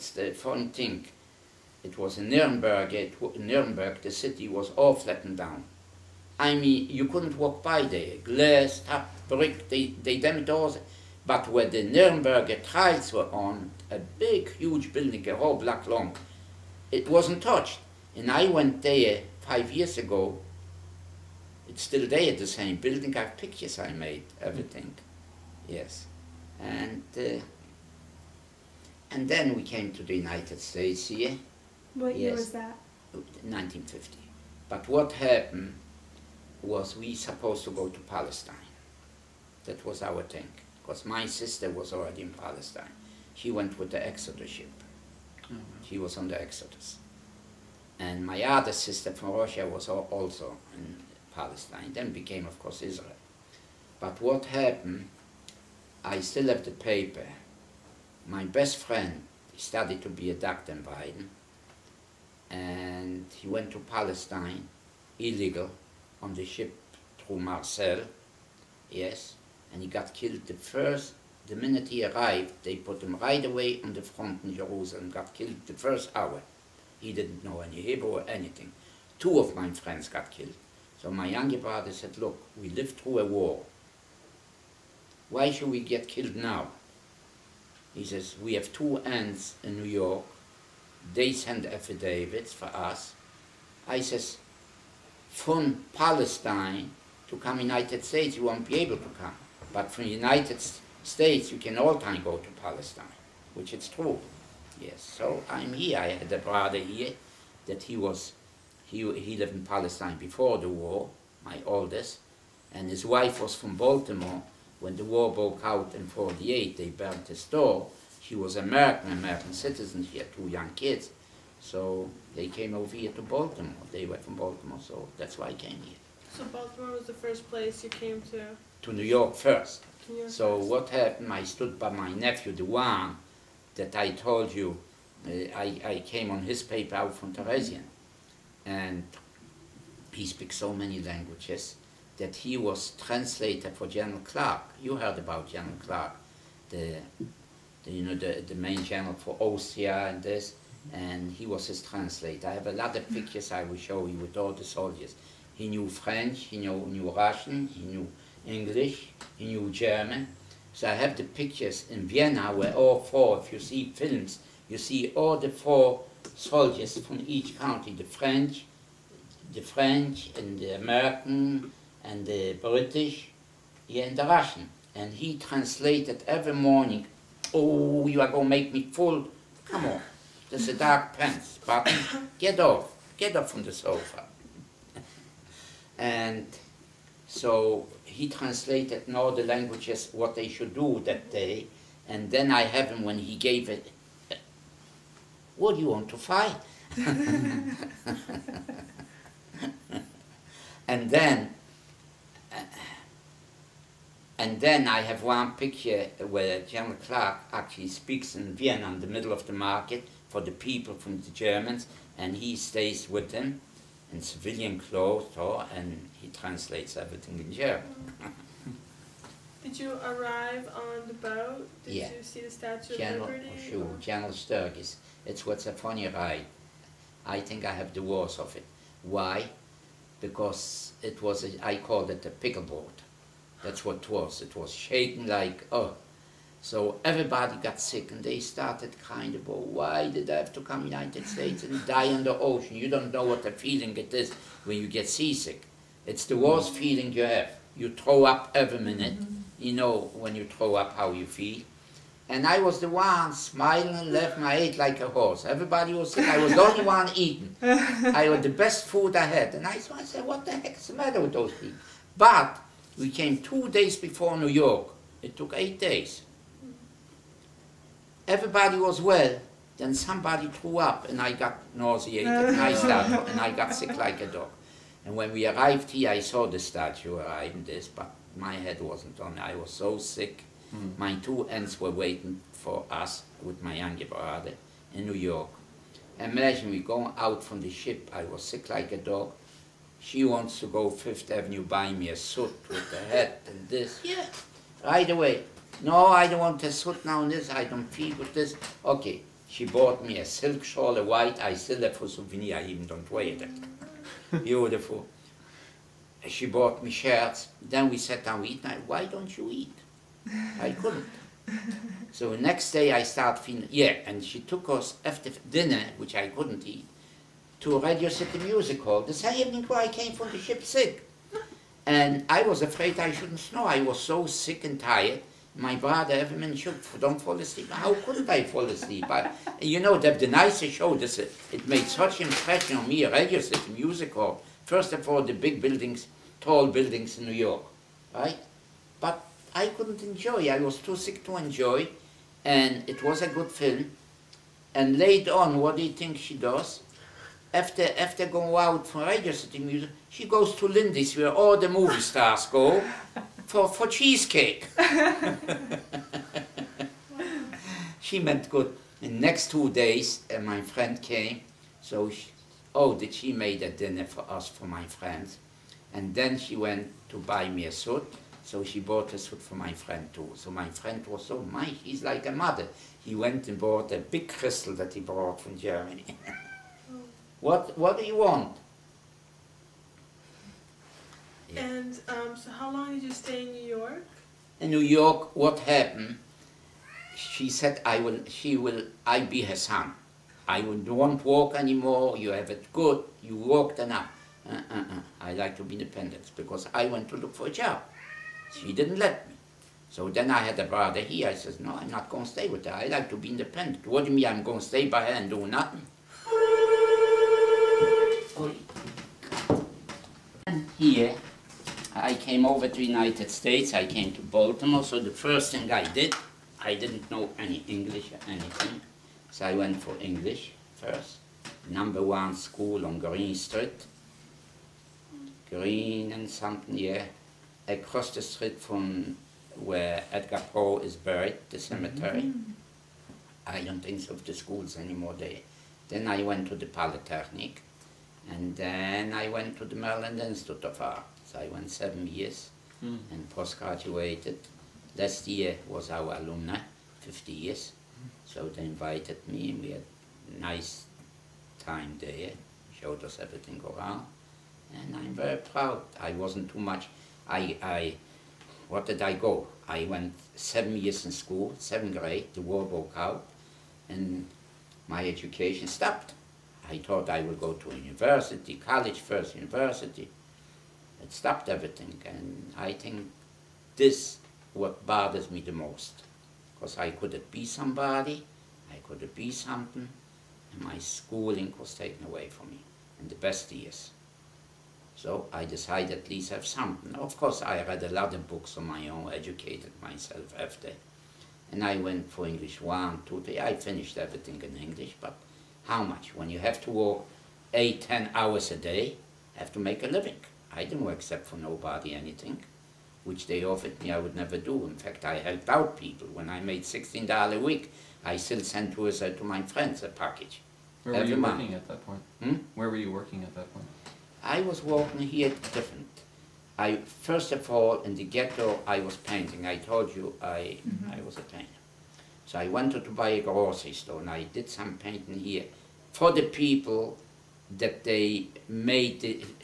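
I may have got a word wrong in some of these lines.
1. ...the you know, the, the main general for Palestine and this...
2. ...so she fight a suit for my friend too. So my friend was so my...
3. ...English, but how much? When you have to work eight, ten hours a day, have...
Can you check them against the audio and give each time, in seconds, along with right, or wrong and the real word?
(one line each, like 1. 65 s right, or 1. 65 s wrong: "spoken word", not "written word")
1. 147 s wrong: "Austria", not "Palestine"
2. 368 s wrong: "bought", not "fight"
3. 494 s right.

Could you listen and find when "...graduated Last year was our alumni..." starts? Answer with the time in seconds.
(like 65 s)
443 s.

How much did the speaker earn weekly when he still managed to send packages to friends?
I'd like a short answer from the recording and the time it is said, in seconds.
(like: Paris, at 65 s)
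$16, at 506 s.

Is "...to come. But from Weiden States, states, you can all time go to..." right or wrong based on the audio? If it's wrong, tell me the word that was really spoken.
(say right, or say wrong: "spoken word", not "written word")
wrong: "United", not "Weiden".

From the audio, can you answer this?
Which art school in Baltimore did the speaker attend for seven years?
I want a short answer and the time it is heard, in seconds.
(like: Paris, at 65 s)
Maryland Institute of Art, at 439 s.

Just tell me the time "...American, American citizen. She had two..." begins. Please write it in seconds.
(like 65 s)
118 s.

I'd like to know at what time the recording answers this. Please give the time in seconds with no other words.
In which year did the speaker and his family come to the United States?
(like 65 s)
33 s.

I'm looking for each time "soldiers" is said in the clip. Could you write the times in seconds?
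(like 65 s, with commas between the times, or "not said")
154 s, 166 s.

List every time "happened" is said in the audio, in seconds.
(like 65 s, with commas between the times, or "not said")
35 s, 54 s, 130 s, 385 s.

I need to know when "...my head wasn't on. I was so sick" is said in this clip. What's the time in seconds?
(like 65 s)
278 s.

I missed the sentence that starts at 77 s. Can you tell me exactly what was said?
He didn't know any Hebrew or anything.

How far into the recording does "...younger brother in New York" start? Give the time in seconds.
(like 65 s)
283 s.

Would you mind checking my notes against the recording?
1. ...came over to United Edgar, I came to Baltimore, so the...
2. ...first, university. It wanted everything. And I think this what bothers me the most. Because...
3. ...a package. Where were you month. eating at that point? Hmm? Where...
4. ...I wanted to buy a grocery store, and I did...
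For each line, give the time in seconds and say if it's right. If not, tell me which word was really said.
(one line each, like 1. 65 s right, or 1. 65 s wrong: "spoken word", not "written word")
1. 412 s wrong: "States", not "Edgar"
2. 469 s wrong: "stopped", not "wanted"
3. 509 s wrong: "working", not "eating"
4. 522 s right.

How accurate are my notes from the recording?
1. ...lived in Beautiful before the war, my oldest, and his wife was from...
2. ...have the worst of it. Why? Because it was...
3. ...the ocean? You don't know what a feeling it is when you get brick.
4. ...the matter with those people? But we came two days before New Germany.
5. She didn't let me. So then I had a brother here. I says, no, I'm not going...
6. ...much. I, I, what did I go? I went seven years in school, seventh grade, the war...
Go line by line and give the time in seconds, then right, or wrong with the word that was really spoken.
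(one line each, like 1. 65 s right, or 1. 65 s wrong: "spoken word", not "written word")
1. 109 s wrong: "Palestine", not "Beautiful"
2. 227 s right
3. 242 s wrong: "seasick", not "brick"
4. 260 s wrong: "York", not "Germany"
5. 398 s right
6. 456 s right.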